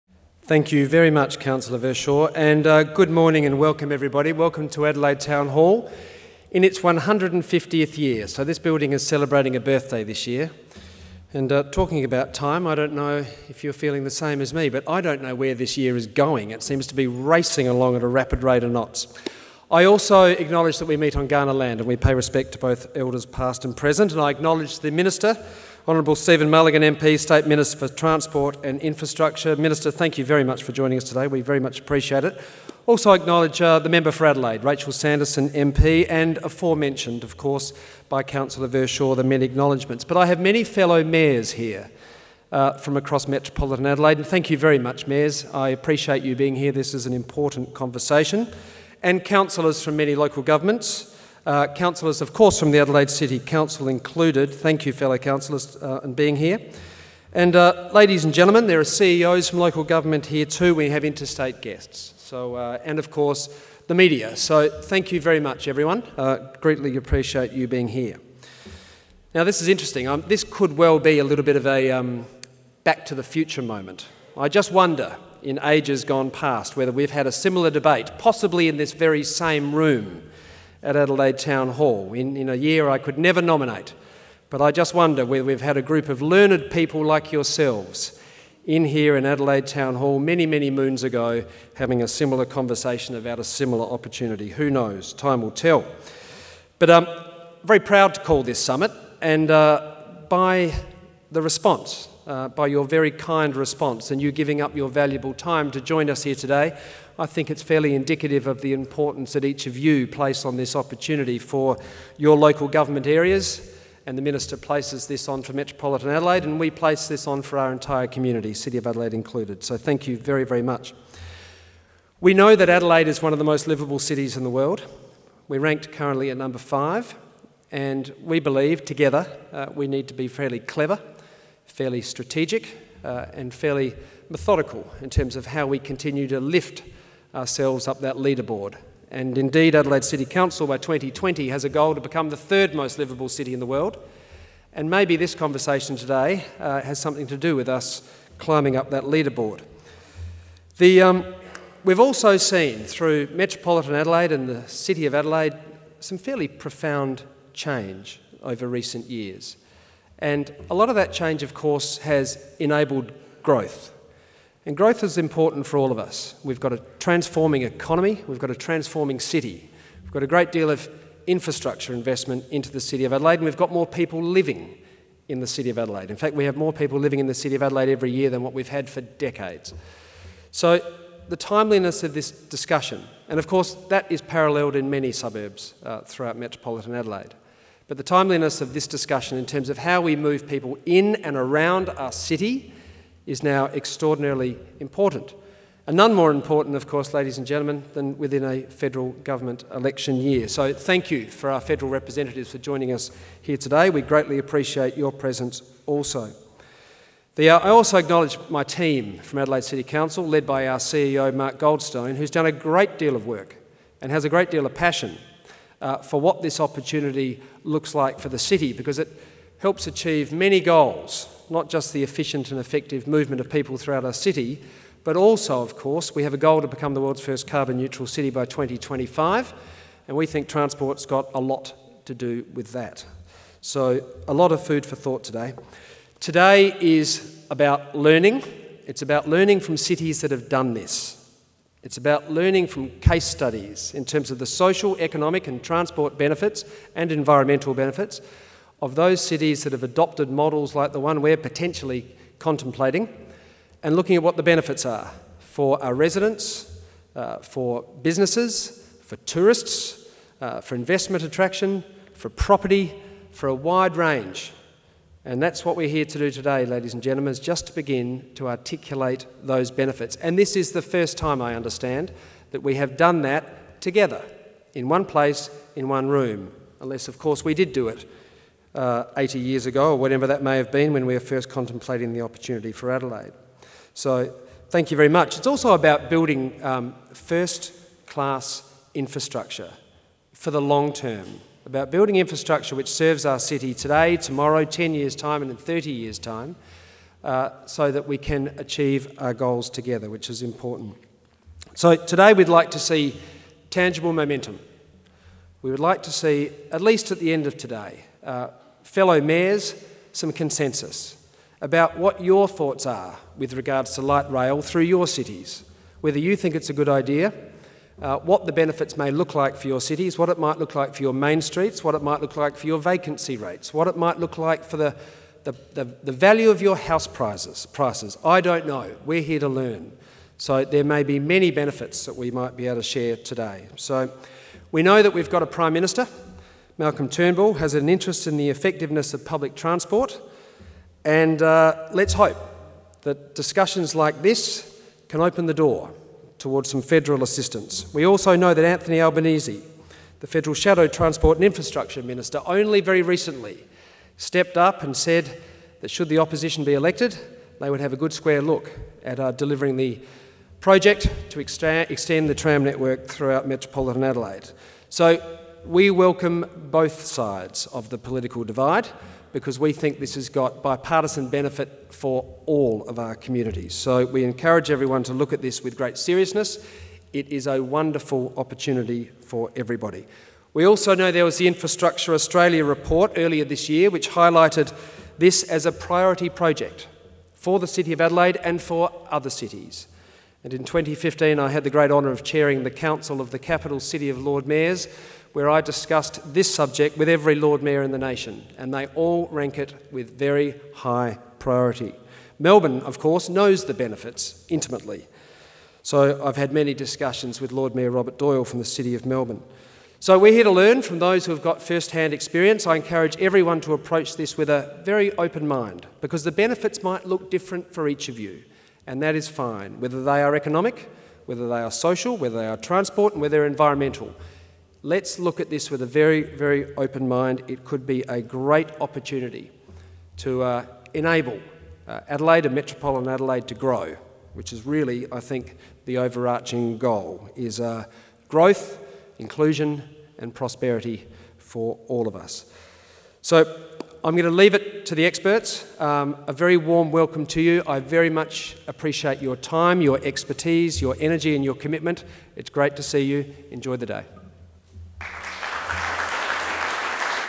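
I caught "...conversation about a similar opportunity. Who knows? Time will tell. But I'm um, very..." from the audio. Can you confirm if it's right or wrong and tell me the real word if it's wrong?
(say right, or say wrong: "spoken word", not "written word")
right.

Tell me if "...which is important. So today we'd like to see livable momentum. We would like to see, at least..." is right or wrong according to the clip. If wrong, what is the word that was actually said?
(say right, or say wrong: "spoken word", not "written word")
wrong: "tangible", not "livable".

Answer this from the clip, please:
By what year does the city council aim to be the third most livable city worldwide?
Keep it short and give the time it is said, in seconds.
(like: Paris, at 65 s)
2020, at 140 s.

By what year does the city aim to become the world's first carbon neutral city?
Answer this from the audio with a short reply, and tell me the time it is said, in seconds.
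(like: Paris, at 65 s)
2025, at 228 s.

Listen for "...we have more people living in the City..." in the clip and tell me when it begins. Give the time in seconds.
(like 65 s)
176 s.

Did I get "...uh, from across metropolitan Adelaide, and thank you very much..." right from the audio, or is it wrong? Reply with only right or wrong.
right.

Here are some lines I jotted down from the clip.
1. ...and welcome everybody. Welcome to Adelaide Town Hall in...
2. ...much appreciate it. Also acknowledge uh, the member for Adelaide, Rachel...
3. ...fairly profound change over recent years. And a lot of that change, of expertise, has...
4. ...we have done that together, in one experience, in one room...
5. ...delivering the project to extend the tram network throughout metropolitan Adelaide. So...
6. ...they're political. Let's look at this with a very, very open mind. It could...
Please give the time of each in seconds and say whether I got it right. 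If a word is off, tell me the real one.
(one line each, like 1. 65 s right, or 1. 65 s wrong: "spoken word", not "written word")
1. 3 s right
2. 31 s right
3. 156 s wrong: "course", not "expertise"
4. 272 s wrong: "place", not "experience"
5. 359 s right
6. 423 s wrong: "environmental", not "political".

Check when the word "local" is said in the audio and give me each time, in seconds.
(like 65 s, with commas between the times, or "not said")
50 s, 59 s, 112 s.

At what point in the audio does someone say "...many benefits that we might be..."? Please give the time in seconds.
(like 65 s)
331 s.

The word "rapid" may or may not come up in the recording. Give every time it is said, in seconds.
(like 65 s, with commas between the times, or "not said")
18 s.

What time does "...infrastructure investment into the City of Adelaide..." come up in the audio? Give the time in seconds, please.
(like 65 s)
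171 s.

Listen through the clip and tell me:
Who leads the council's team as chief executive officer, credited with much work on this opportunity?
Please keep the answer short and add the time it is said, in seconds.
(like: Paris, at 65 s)
Mark Goldstone, at 211 s.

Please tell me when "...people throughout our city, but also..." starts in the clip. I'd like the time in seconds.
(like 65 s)
223 s.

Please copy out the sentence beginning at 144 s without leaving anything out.
And maybe this conversation today uh, has something to do with us climbing up that leaderboard.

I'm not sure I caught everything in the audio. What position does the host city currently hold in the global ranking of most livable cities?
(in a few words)
5.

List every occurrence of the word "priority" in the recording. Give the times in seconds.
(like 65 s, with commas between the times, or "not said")
385 s, 401 s.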